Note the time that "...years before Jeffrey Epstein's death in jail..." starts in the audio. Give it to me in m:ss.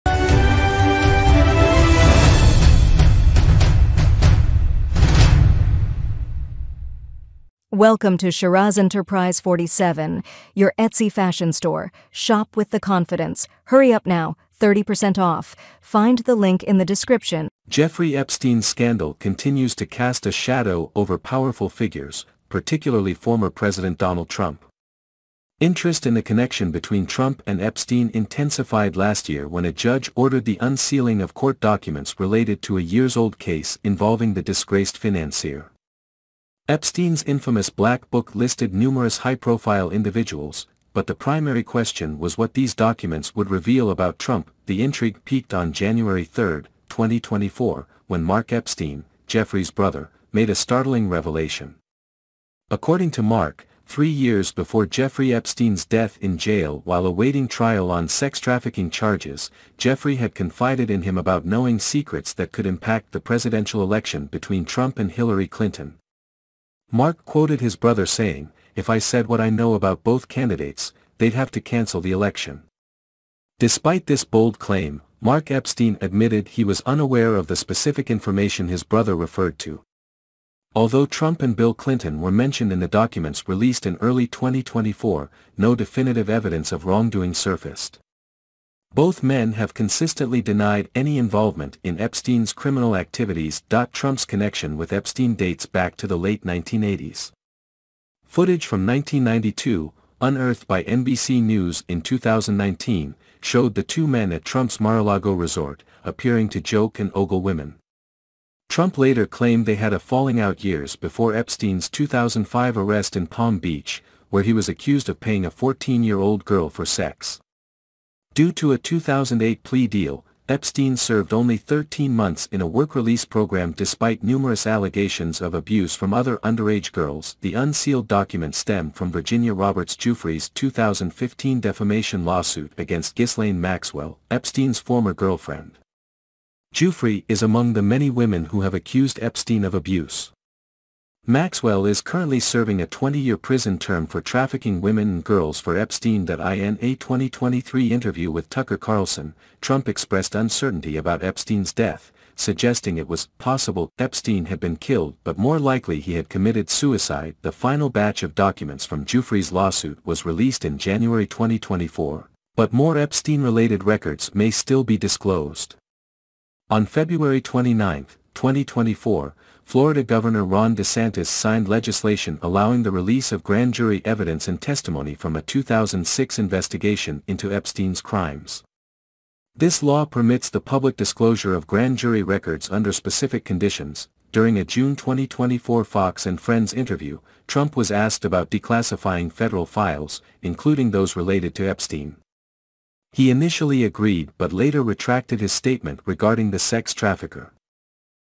0:54.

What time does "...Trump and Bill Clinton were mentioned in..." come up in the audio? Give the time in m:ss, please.
1:21.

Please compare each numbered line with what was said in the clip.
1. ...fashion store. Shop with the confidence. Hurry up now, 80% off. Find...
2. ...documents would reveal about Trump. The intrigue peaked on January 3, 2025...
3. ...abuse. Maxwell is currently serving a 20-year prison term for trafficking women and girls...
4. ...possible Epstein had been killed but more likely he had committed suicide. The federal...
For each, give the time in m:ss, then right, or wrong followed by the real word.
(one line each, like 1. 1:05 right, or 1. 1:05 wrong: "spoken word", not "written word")
1. 0:11 wrong: "30", not "80"
2. 0:42 wrong: "2024", not "2025"
3. 2:19 right
4. 2:33 wrong: "final", not "federal".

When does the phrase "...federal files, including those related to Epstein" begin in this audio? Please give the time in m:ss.
3:09.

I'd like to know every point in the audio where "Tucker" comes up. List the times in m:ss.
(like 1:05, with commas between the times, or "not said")
2:28.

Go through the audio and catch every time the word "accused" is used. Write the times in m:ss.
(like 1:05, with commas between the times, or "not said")
1:54, 2:18.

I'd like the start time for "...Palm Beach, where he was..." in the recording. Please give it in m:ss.
1:53.